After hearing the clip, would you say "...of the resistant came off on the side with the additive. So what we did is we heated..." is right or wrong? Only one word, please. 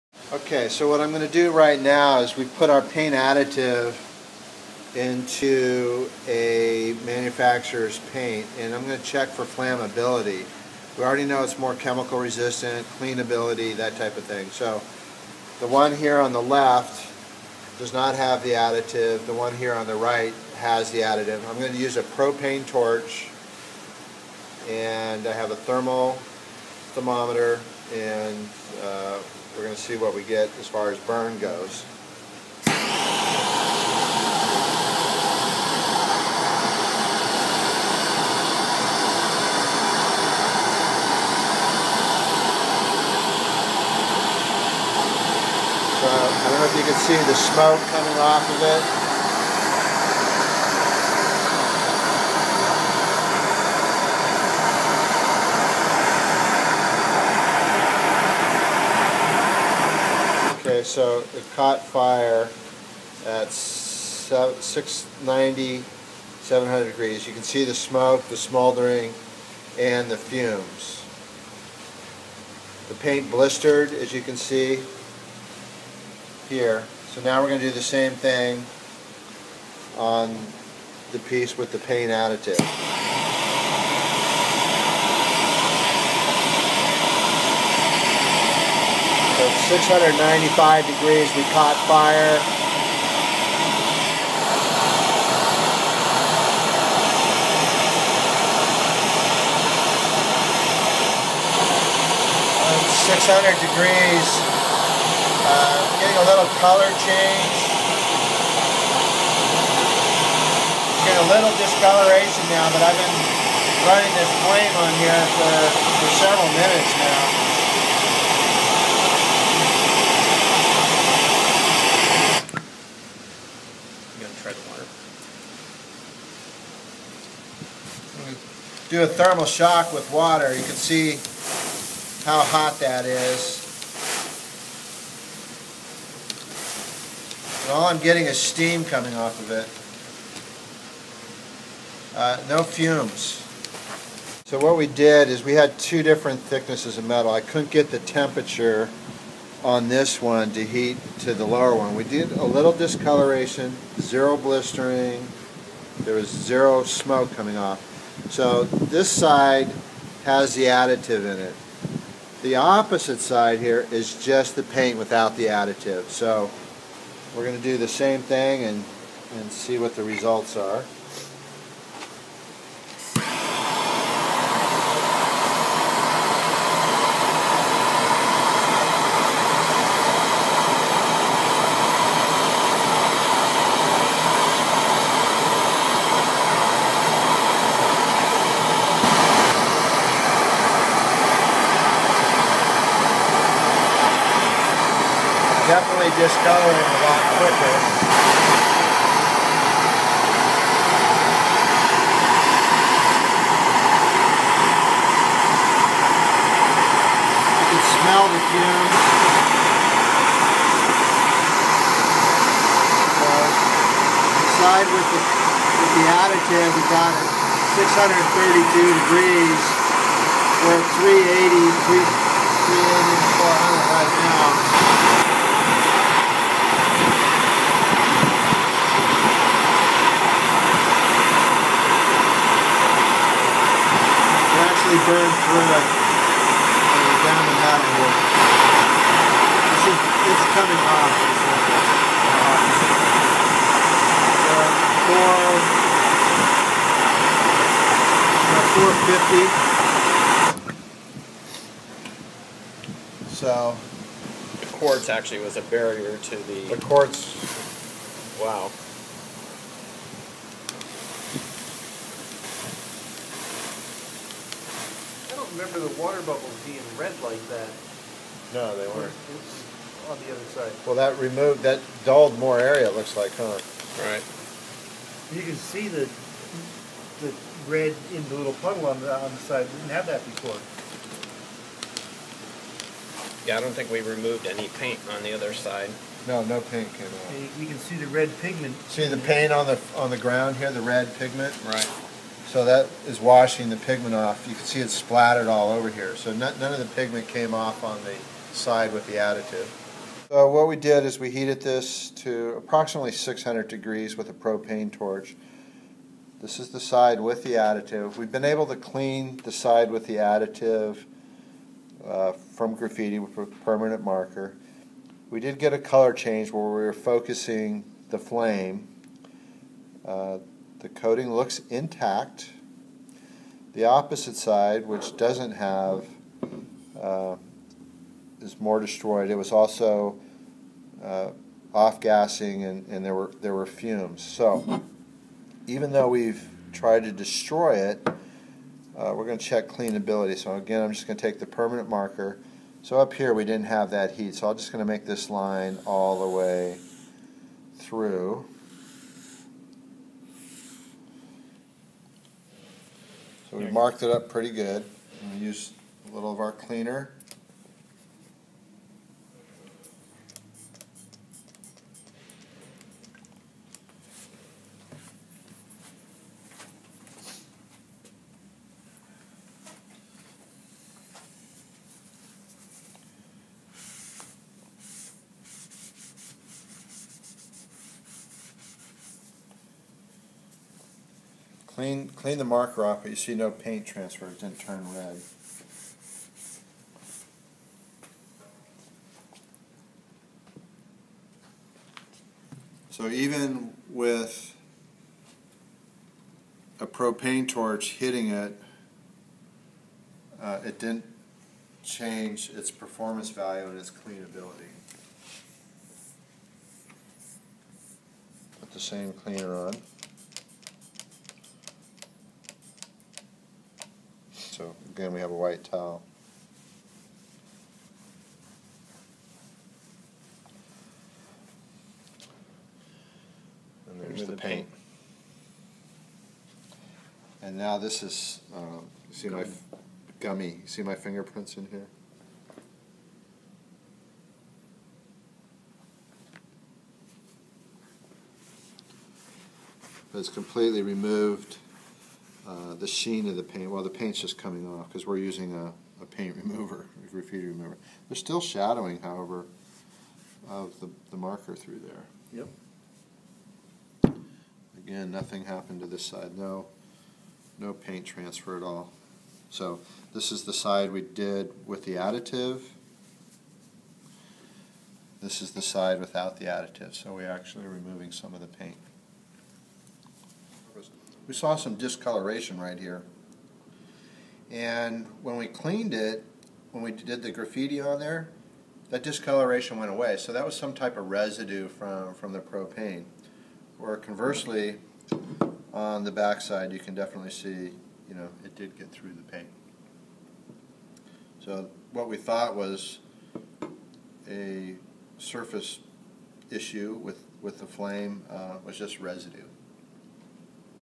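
wrong.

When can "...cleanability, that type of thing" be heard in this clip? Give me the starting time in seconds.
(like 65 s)
12 s.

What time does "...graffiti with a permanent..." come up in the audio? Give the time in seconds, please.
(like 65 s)
312 s.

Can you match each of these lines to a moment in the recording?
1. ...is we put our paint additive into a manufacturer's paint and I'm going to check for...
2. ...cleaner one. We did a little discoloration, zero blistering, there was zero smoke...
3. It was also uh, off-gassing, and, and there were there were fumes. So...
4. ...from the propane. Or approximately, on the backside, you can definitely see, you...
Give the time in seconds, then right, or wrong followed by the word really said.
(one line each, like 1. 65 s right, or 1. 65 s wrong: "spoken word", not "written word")
1. 2 s right
2. 151 s wrong: "lower", not "cleaner"
3. 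329 s right
4. 482 s wrong: "conversely", not "approximately".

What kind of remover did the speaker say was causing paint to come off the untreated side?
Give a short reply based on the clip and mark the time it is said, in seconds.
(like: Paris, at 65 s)
graffiti remover, at 447 s.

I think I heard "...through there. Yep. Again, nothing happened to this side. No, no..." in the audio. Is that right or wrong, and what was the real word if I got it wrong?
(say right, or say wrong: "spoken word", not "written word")
right.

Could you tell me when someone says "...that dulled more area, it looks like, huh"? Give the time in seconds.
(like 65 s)
271 s.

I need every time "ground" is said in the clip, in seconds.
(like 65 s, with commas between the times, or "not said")
290 s.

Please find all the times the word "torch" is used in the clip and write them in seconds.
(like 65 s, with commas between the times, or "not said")
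22 s, 304 s, 397 s.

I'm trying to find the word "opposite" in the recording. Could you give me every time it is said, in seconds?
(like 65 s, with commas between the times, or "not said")
162 s, 323 s.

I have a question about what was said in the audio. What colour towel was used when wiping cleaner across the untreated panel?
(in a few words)
white.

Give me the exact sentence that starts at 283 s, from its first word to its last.
Yeah, I don't think we removed any paint on the other side.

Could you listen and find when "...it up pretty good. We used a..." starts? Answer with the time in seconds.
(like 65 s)
354 s.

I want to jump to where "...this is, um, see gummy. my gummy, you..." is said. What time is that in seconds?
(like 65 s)
427 s.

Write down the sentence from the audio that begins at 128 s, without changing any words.
do a thermal shock with water, you can see how hot that is.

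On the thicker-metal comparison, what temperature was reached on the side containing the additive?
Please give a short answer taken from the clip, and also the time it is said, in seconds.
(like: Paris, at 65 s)
632 degrees, at 217 s.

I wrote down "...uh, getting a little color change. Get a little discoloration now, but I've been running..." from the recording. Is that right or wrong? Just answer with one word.
right.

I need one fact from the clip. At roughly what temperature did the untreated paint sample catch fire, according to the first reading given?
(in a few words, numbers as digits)
690.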